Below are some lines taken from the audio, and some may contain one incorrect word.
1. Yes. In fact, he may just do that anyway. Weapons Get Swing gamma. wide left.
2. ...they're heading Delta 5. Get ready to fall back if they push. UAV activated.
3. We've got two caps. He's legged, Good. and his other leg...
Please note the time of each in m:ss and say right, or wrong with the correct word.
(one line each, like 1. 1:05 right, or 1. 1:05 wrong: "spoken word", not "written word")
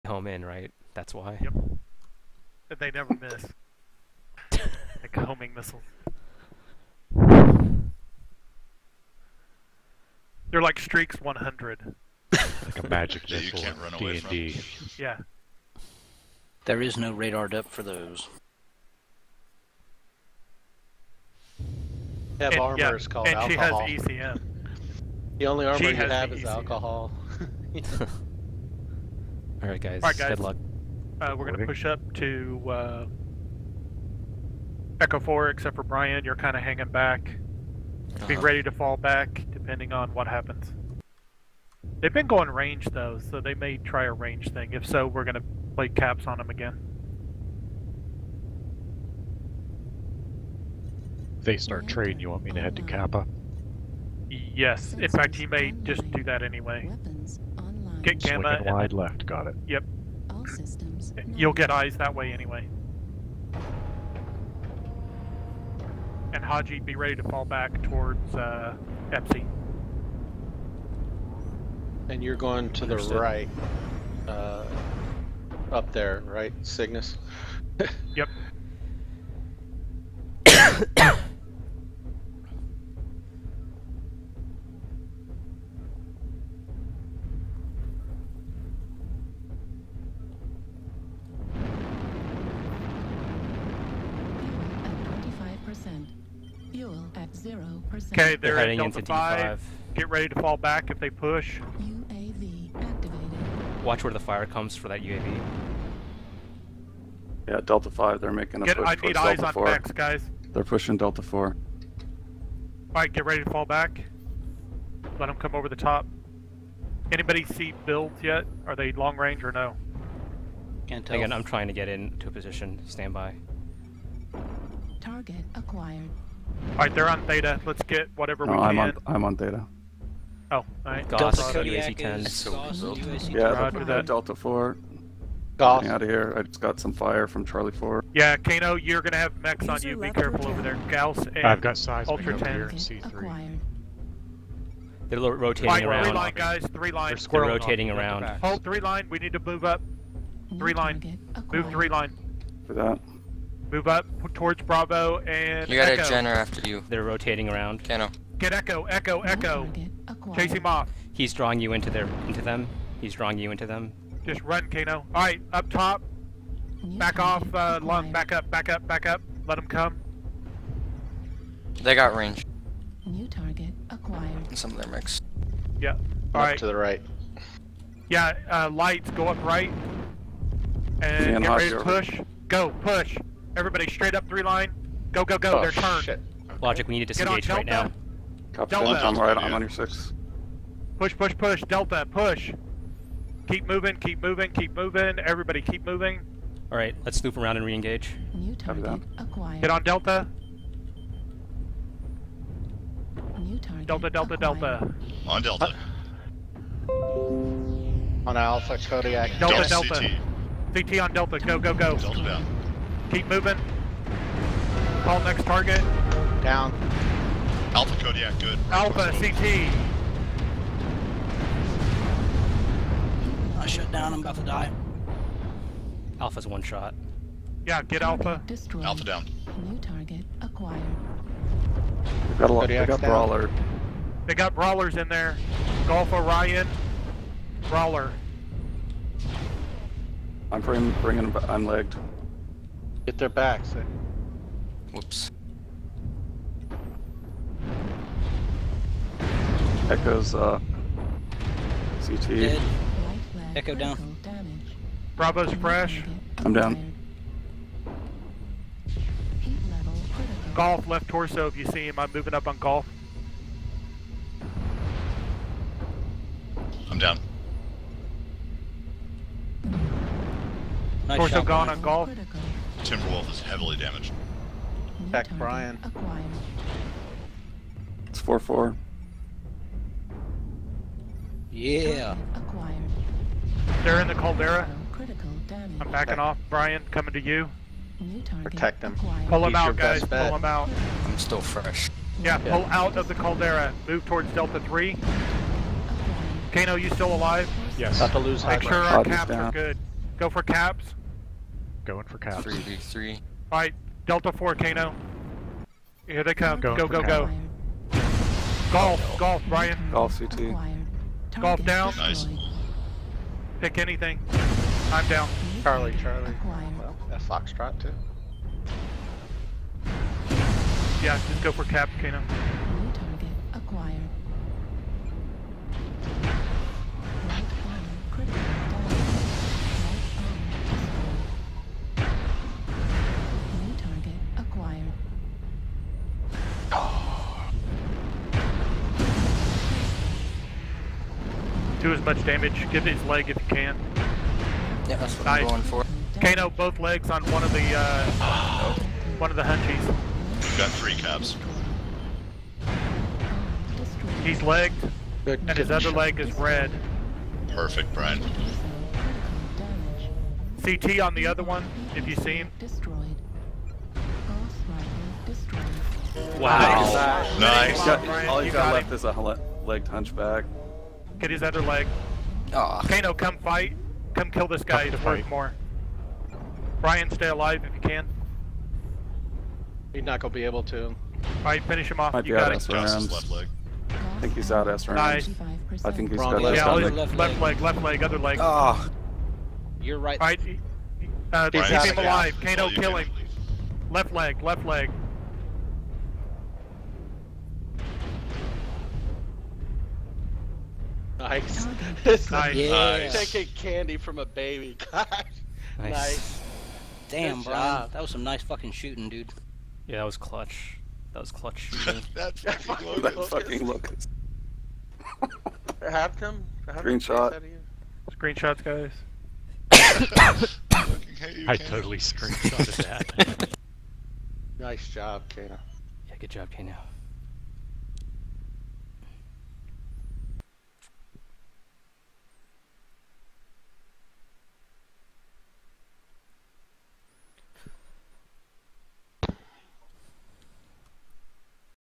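1. 0:54 right
2. 1:38 right
3. 5:49 wrong: "three", not "two".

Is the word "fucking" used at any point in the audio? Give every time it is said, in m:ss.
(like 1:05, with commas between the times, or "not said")
6:48, 6:52.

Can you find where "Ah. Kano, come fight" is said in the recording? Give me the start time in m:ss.
6:12.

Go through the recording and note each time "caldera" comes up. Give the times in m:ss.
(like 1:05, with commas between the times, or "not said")
4:44, 4:53.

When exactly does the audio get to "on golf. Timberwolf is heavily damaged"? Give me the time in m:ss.
4:31.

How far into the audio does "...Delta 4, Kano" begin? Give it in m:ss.
5:04.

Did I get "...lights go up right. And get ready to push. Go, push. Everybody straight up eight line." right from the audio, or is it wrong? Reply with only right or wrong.
wrong.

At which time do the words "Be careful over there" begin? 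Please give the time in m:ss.
2:19.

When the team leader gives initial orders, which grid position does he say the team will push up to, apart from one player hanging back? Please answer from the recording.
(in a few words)
Echo 4.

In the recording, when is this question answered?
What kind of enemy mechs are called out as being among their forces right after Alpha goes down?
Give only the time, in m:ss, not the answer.
3:54.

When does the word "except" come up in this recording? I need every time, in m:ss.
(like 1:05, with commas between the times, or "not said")
0:35.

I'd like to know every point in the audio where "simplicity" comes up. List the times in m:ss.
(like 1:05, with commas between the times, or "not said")
not said.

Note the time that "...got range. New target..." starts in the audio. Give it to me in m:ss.
2:51.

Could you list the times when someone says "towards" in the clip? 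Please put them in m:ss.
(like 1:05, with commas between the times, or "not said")
1:07, 2:34, 4:54.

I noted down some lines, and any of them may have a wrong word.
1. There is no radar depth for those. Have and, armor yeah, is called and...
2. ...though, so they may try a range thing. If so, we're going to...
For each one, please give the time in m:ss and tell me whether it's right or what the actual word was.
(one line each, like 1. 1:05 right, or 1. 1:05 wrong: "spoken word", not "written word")
1. 0:16 right
2. 0:42 right.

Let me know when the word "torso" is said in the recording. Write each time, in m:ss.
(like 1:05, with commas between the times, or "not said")
4:21, 4:31.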